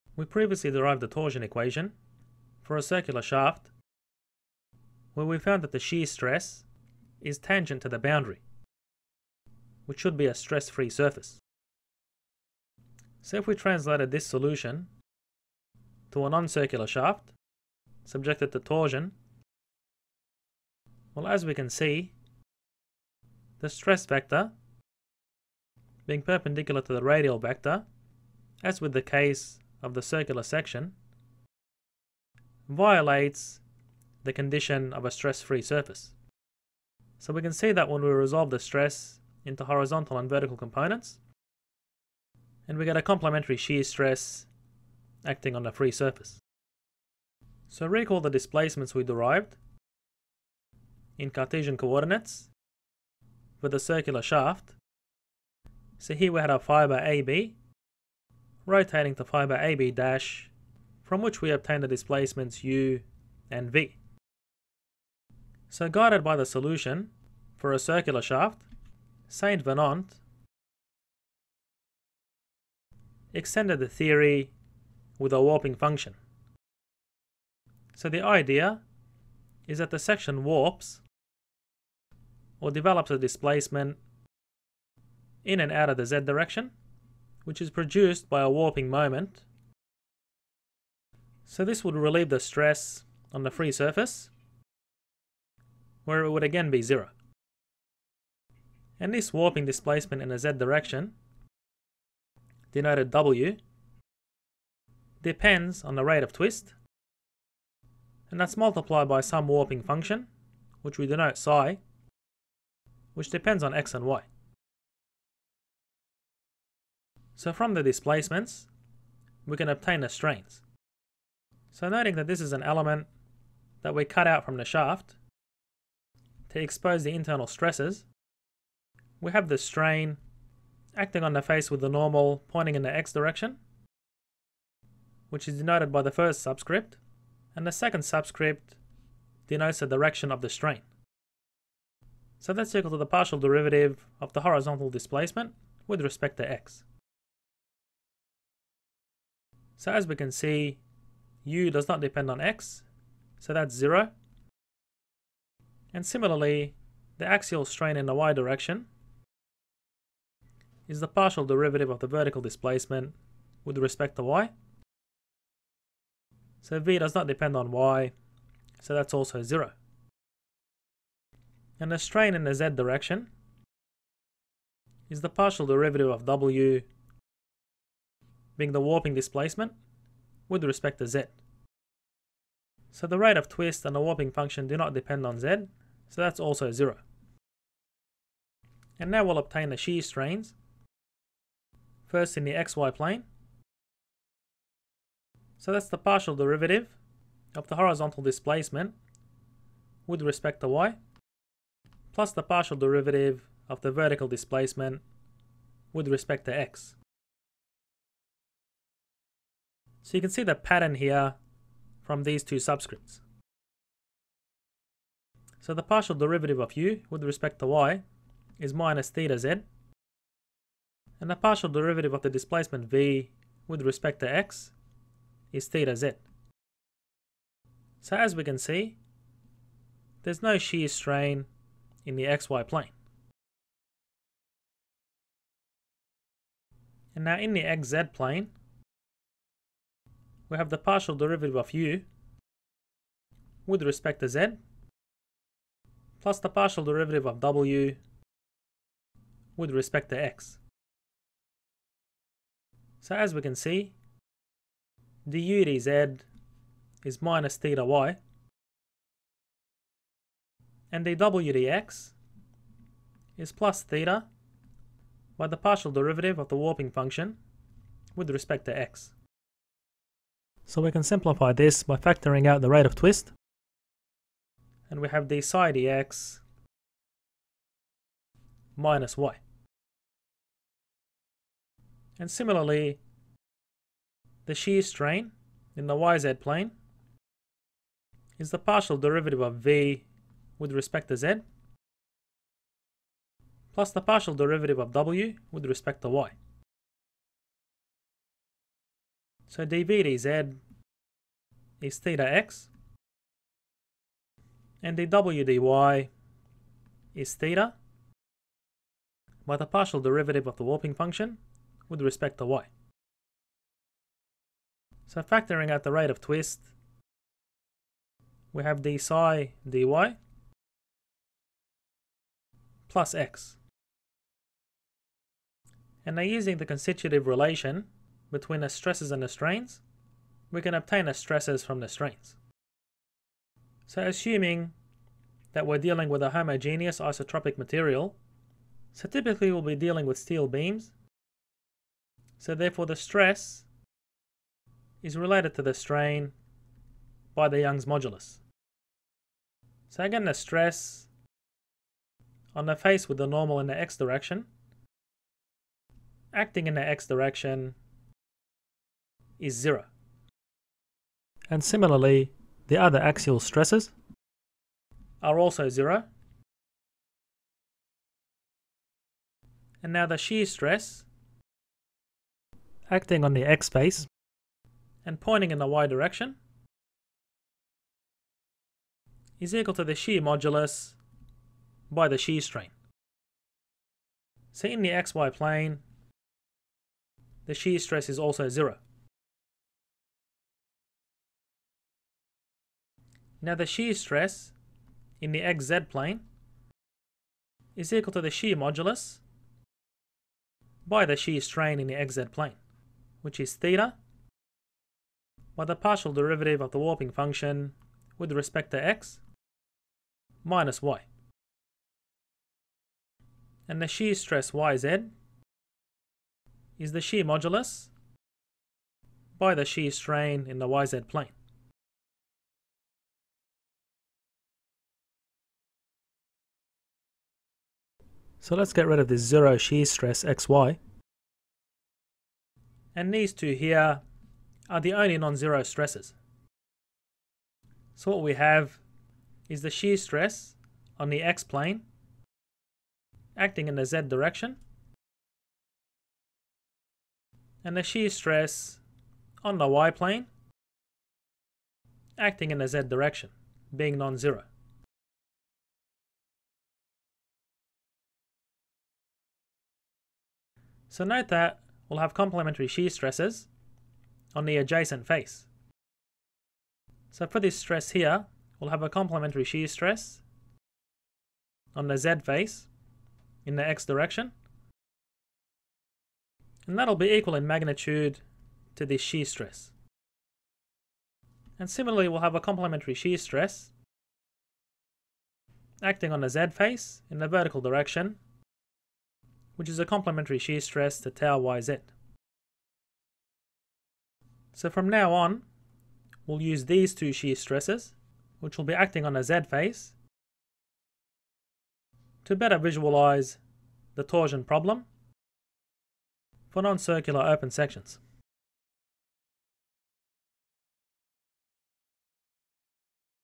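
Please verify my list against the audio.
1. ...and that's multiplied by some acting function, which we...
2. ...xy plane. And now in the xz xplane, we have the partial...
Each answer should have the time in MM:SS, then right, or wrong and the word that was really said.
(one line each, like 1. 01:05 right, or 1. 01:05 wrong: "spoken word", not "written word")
1. 01:48 wrong: "warping", not "acting"
2. 03:52 wrong: "plane", not "xplane".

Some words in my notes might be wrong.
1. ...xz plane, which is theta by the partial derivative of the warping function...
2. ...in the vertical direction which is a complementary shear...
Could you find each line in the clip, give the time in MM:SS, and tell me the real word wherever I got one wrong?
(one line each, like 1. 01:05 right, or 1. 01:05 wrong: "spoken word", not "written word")
1. 06:41 right
2. 08:07 right.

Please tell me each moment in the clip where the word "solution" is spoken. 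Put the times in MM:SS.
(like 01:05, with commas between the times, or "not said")
00:14, 01:06.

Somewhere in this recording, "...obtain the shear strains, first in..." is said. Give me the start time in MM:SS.
03:09.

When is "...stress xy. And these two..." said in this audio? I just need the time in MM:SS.
07:09.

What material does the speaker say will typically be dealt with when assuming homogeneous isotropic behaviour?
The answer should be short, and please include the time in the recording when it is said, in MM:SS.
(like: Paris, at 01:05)
steel beams, at 05:40.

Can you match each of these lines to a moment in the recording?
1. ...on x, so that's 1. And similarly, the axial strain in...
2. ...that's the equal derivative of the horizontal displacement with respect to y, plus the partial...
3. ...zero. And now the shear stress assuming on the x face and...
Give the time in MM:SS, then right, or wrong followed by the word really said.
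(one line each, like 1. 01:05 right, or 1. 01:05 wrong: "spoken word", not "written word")
1. 02:32 wrong: "0", not "1"
2. 03:15 wrong: "partial", not "equal"
3. 06:05 wrong: "acting", not "assuming".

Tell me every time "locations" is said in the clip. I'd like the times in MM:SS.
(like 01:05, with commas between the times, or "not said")
not said.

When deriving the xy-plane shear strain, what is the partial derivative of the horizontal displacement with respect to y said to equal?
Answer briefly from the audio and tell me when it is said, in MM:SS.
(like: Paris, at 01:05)
minus theta z, at 03:38.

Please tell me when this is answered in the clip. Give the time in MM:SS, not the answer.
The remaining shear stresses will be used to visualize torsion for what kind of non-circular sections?
08:27.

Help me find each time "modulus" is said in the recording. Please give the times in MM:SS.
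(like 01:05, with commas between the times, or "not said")
05:47, 06:20, 06:38, 06:57.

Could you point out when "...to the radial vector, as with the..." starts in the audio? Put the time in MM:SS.
00:26.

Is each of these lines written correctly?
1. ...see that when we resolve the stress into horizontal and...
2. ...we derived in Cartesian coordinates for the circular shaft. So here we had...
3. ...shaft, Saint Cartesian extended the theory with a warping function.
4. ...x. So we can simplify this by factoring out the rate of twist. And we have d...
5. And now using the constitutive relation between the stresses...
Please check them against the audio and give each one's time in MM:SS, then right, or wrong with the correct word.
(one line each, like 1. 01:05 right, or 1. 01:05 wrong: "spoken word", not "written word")
1. 00:37 right
2. 00:48 right
3. 01:08 wrong: "Venant", not "Cartesian"
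4. 04:28 right
5. 05:26 right.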